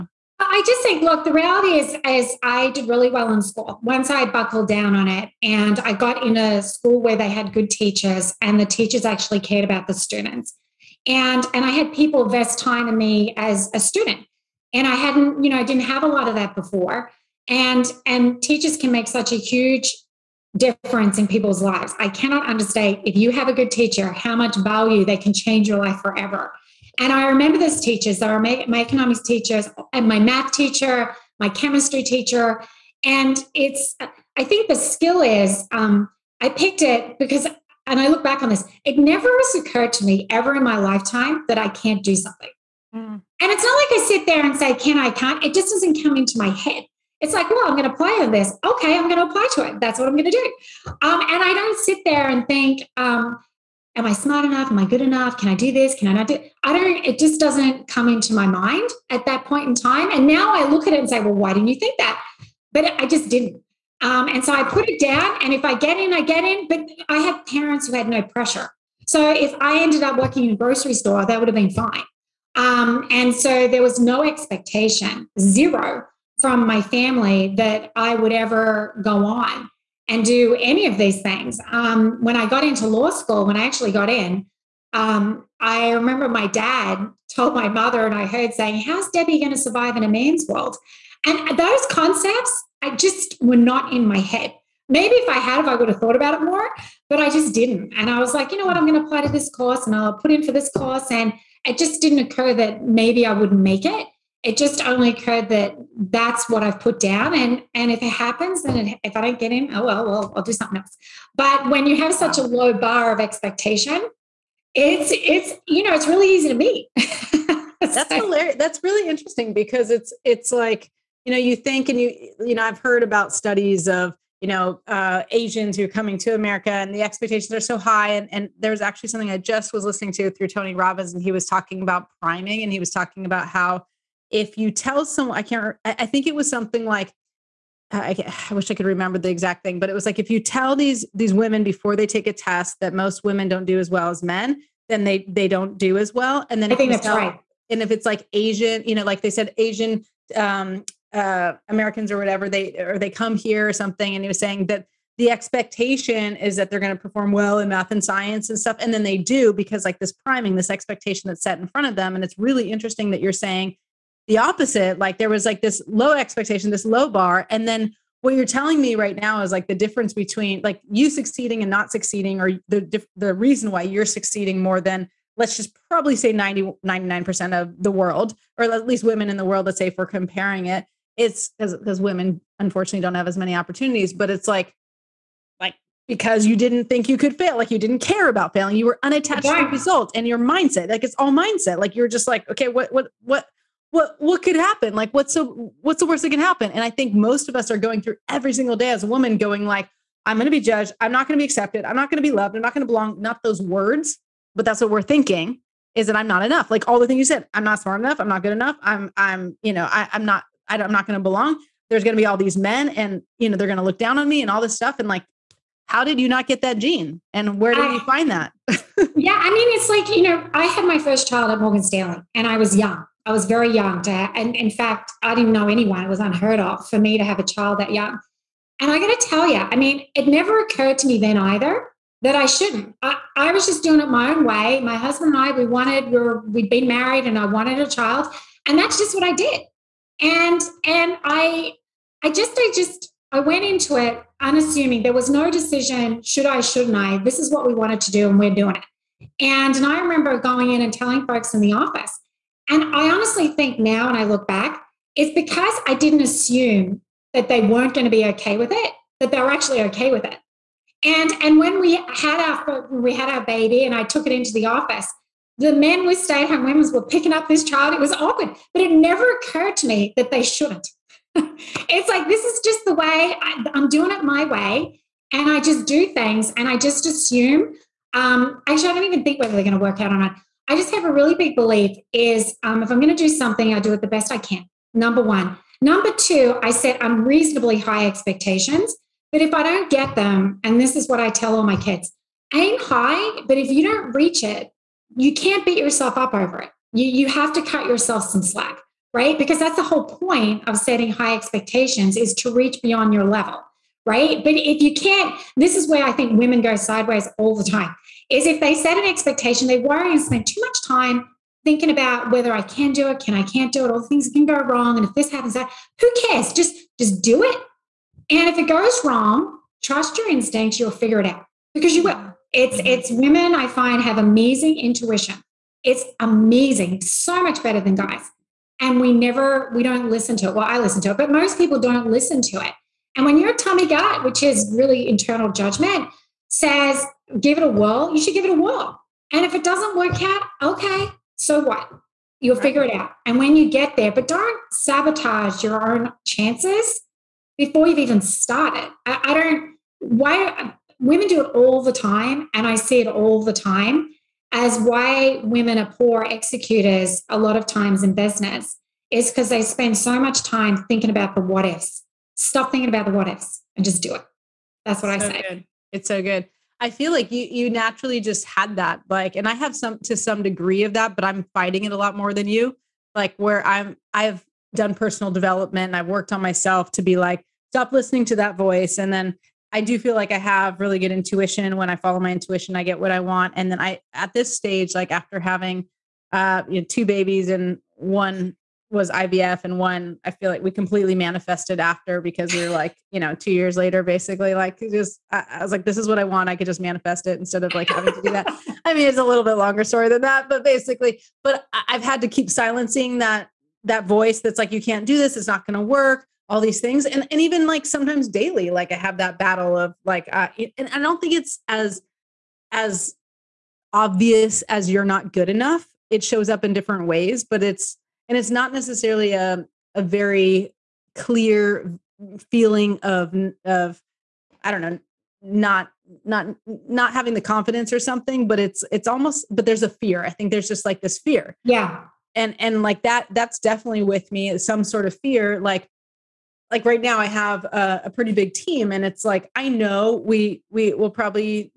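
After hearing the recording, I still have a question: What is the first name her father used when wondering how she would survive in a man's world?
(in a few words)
Debbie.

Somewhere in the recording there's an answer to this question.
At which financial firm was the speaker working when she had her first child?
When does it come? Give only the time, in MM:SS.
03:41.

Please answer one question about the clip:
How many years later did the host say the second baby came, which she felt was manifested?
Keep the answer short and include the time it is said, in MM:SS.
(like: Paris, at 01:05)
2, at 06:33.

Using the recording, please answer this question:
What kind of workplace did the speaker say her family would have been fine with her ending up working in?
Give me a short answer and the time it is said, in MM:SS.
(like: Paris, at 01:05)
grocery store, at 01:10.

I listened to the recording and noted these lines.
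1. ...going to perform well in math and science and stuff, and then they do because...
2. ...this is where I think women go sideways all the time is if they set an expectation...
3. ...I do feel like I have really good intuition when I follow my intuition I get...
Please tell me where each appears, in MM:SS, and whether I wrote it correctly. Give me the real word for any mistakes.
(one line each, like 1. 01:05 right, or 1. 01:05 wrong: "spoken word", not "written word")
1. 02:36 right
2. 05:05 right
3. 06:19 right.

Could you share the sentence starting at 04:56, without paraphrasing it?
You, you have to cut yourself some slack, right?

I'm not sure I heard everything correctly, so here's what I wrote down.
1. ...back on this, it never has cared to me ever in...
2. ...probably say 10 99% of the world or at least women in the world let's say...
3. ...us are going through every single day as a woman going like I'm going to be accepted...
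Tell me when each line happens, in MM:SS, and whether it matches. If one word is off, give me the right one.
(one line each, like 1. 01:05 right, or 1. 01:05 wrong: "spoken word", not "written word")
1. 00:38 wrong: "occurred", not "cared"
2. 02:55 wrong: "90", not "10"
3. 03:17 wrong: "judged", not "accepted".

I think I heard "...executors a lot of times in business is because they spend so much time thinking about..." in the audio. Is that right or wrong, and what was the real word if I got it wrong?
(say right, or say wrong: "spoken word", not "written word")
right.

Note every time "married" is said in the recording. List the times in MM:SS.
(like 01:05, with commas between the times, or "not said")
03:56.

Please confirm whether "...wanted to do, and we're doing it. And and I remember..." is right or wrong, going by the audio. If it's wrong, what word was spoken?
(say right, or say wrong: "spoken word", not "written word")
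right.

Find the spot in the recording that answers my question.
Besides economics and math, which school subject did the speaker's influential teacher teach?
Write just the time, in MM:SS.
00:31.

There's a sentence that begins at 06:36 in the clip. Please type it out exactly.
I could just manifest it instead of like having to do that.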